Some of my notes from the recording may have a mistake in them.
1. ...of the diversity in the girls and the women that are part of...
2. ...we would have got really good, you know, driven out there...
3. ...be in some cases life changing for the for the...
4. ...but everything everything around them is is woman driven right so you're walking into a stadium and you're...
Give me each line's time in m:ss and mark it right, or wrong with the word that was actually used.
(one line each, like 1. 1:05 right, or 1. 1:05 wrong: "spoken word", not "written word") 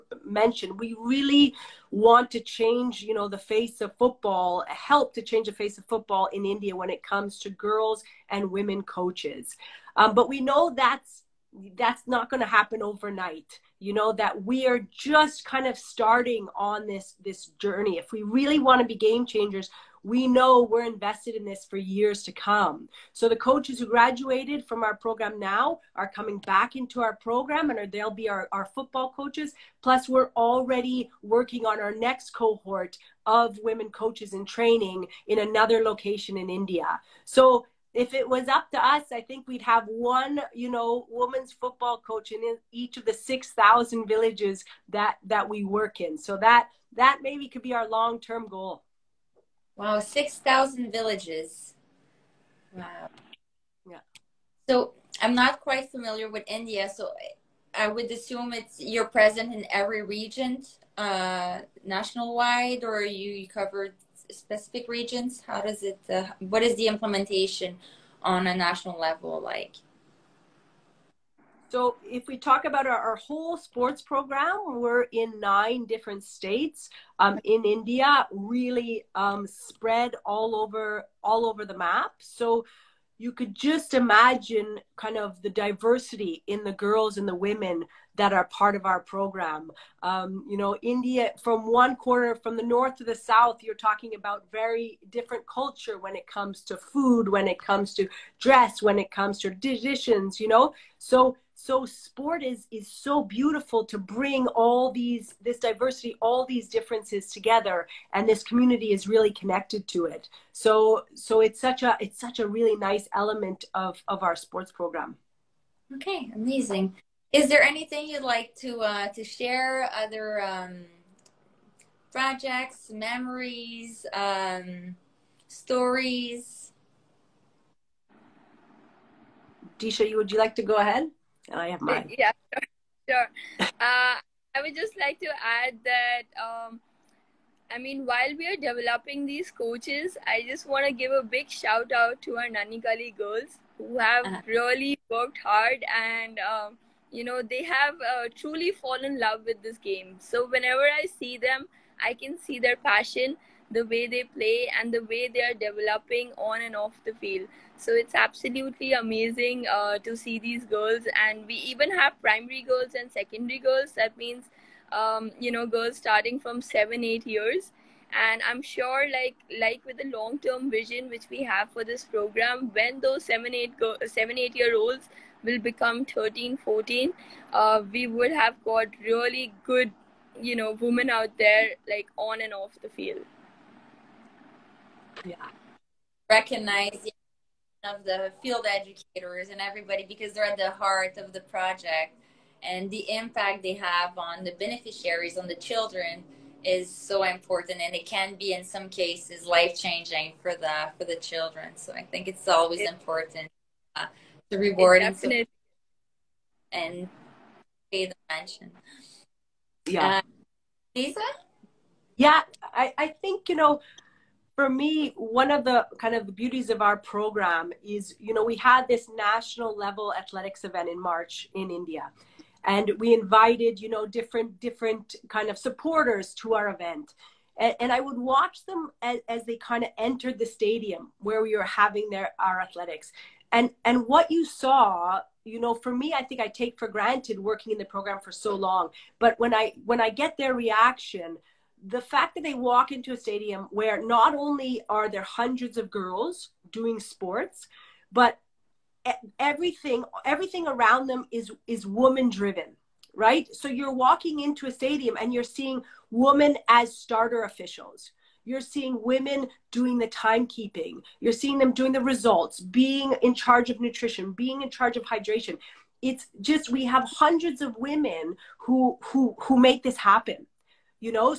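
1. 1:25 right
2. 2:57 wrong: "women", not "driven"
3. 3:18 right
4. 4:08 right.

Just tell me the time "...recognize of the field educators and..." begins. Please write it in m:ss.
3:06.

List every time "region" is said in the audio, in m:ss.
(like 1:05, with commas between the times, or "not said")
1:00, 1:04.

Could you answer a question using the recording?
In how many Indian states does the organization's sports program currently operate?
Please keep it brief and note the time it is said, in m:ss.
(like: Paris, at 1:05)
9, at 1:15.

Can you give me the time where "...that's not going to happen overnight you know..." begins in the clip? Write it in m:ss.
0:11.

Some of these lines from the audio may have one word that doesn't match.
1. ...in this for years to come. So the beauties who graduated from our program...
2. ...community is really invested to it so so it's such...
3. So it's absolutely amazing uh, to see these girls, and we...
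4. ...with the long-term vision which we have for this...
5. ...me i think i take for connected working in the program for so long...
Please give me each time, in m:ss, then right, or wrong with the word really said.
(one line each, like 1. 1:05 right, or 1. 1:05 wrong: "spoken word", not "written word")
1. 0:21 wrong: "coaches", not "beauties"
2. 1:48 wrong: "connected", not "invested"
3. 2:37 right
4. 2:49 right
5. 3:55 wrong: "granted", not "connected".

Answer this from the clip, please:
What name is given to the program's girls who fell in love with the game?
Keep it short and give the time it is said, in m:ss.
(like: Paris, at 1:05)
Nanhi Kali, at 2:22.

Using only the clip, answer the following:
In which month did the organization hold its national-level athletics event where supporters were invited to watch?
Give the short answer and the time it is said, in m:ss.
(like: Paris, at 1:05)
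March, at 3:40.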